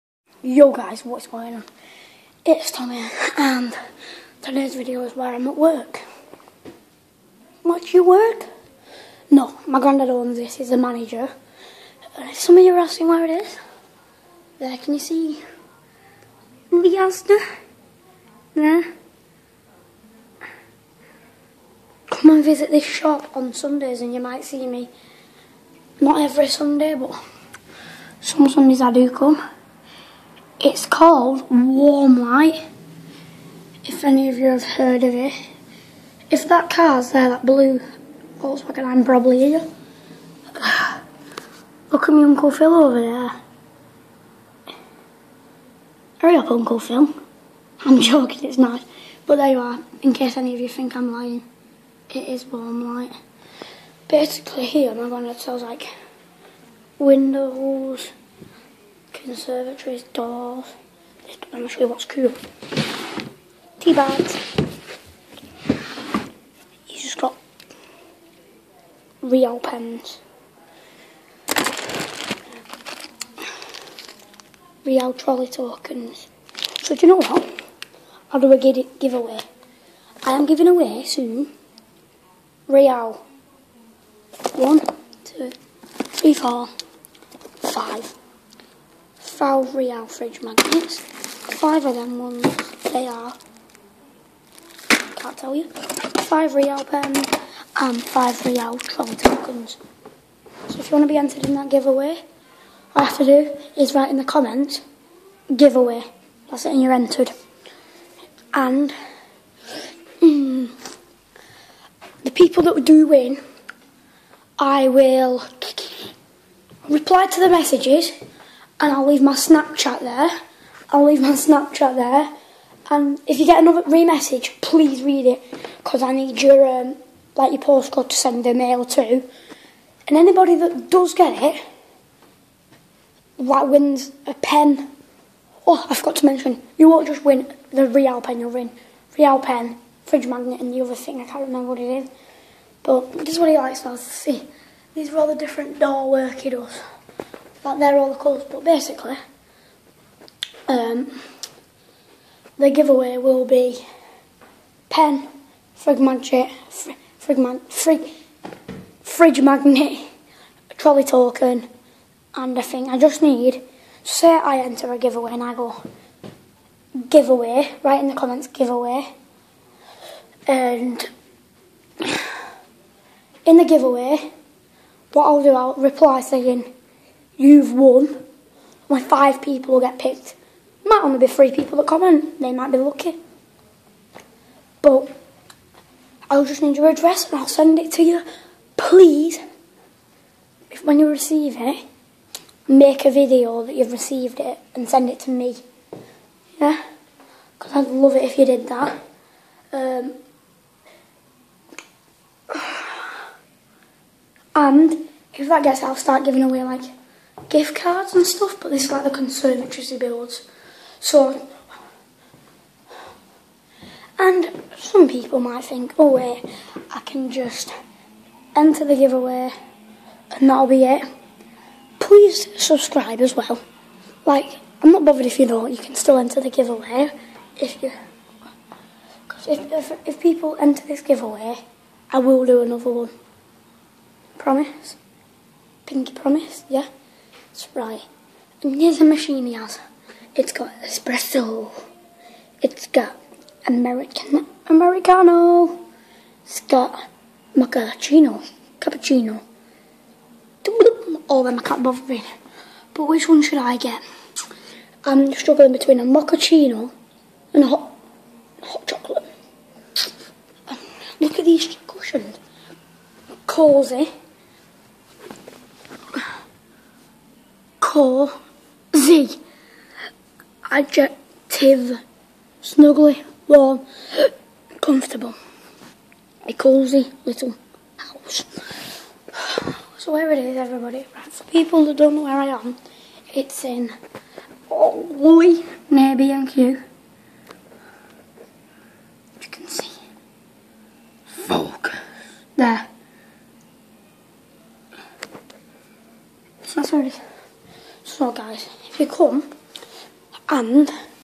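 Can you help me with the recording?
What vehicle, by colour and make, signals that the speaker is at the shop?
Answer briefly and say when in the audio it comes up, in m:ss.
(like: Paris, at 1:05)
blue Volkswagen, at 0:37.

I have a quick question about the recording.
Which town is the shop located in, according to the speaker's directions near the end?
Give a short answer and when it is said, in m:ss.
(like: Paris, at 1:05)
Wooly, at 4:43.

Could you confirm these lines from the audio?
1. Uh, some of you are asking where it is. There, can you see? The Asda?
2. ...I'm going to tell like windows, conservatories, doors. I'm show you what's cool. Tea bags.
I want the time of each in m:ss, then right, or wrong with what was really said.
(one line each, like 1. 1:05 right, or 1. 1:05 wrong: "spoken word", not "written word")
1. 0:12 right
2. 0:54 right.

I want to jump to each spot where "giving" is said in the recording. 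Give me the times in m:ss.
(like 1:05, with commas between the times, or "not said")
1:20, 3:26.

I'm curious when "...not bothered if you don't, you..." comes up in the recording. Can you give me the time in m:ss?
3:44.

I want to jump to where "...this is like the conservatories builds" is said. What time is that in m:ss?
3:28.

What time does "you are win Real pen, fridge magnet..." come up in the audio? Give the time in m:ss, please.
2:18.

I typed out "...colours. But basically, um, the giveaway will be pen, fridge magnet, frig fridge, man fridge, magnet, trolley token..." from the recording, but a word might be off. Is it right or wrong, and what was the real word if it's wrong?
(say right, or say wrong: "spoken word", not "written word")
right.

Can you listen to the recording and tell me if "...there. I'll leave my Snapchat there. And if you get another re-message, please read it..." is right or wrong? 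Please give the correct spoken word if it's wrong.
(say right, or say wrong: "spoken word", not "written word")
right.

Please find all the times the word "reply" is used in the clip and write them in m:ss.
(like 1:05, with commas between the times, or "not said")
1:56, 2:55.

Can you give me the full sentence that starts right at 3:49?
Because if, if, if people enter this giveaway, I will do another one.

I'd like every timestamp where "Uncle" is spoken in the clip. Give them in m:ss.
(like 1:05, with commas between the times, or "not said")
0:42, 0:46.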